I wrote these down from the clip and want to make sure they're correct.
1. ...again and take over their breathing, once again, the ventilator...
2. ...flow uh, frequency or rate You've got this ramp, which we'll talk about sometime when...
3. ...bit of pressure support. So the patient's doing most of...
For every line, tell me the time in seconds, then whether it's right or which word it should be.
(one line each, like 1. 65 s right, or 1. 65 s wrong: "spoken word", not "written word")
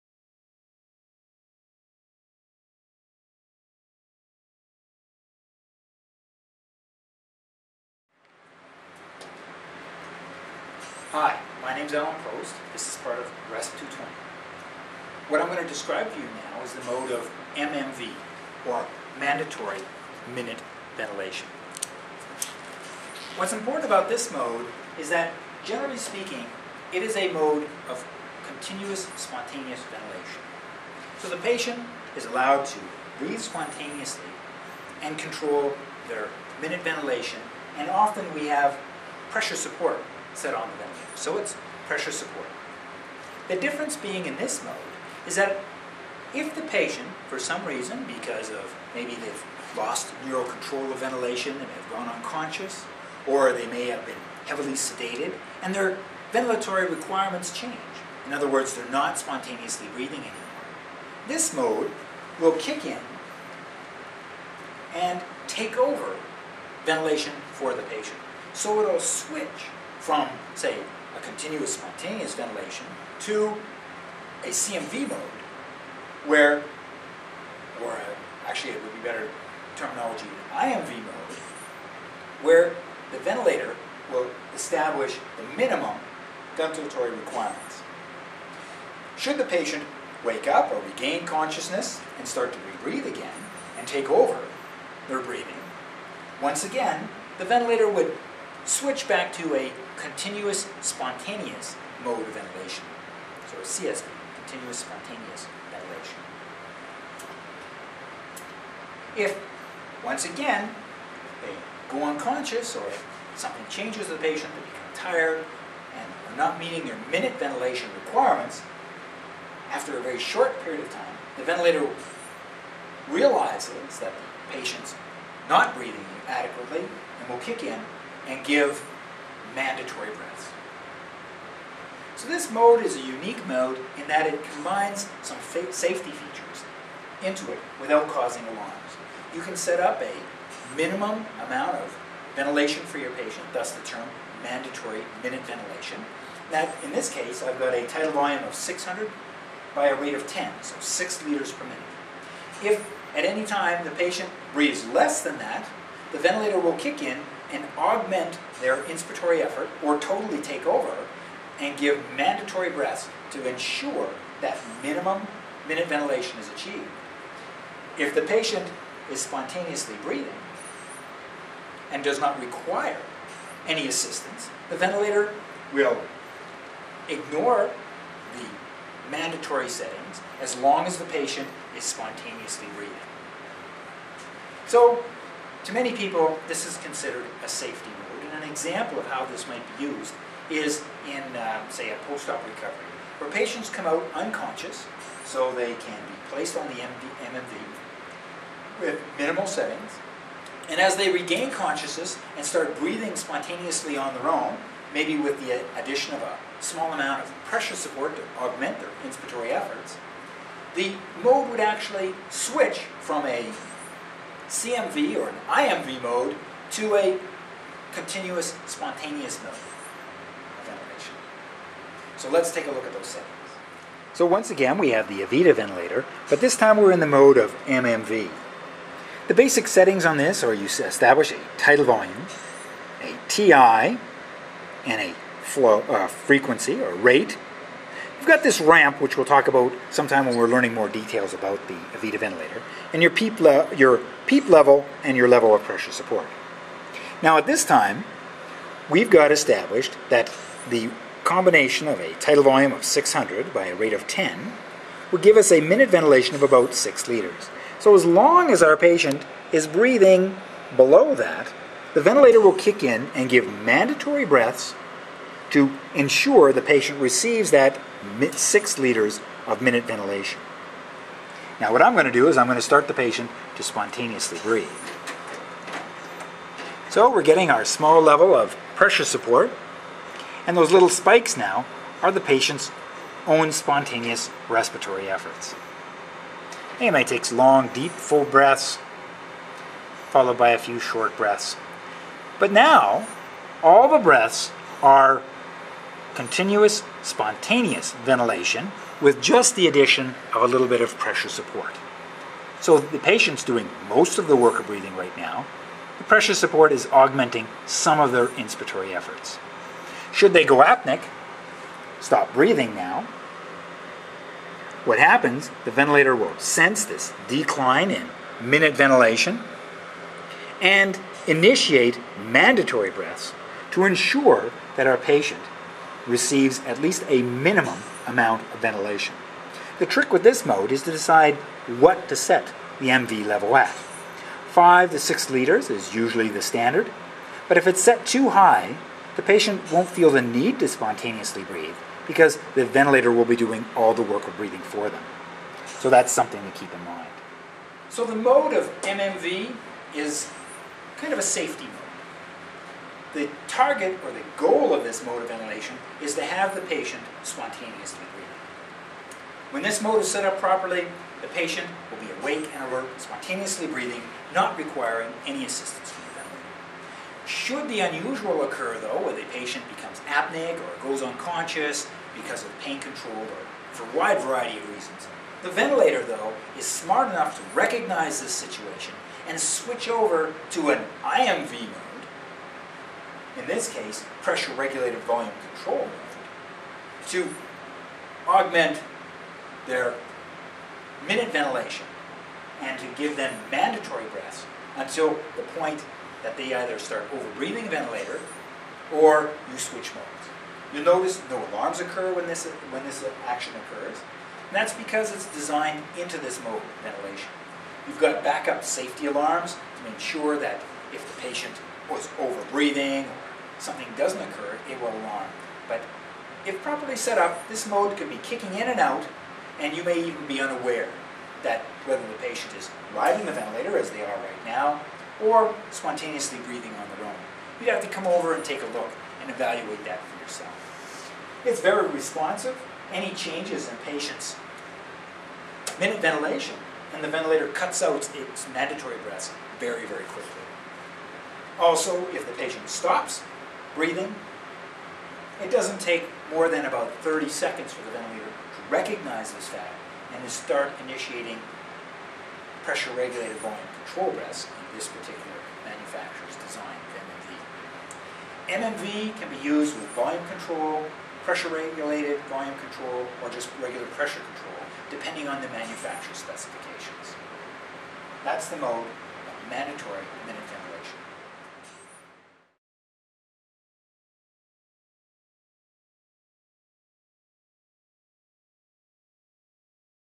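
1. 93 s right
2. 235 s right
3. 300 s right.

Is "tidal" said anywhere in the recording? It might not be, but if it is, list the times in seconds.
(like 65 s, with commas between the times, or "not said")
147 s, 231 s, 252 s.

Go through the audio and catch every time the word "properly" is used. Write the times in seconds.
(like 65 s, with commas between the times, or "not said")
360 s, 416 s.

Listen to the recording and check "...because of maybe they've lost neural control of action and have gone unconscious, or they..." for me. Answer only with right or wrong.
wrong.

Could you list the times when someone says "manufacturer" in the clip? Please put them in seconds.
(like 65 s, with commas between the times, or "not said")
455 s, 465 s.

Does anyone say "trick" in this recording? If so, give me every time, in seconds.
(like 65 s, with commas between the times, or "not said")
329 s.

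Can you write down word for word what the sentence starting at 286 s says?
AMA takes long, deep, full breaths, followed by a few short breaths.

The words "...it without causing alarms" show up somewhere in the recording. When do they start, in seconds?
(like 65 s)
137 s.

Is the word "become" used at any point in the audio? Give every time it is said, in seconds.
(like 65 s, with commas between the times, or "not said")
114 s, 369 s.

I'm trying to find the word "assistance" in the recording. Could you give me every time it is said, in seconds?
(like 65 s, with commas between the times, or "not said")
173 s, 365 s.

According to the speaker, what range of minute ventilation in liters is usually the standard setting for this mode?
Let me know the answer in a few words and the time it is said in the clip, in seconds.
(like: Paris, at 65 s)
5 to 6 liters, at 334 s.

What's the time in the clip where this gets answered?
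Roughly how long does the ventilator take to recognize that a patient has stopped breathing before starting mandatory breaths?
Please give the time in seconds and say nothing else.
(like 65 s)
447 s.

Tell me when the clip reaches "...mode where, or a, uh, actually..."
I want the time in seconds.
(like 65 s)
75 s.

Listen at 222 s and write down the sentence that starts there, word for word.
So let's take a look at those settings.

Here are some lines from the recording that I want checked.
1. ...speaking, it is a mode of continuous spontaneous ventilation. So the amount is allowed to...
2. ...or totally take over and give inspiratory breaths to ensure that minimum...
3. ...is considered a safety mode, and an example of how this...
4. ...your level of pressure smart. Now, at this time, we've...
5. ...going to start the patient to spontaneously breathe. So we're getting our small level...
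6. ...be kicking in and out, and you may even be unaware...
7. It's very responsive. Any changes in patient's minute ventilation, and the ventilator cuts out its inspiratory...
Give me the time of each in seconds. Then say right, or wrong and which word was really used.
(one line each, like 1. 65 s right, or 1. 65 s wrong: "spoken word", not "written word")
1. 25 s wrong: "patient", not "amount"
2. 159 s wrong: "mandatory", not "inspiratory"
3. 186 s right
4. 245 s wrong: "support", not "smart"
5. 272 s right
6. 418 s right
7. 431 s wrong: "mandatory", not "inspiratory".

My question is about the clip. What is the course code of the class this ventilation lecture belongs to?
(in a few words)
REST 220.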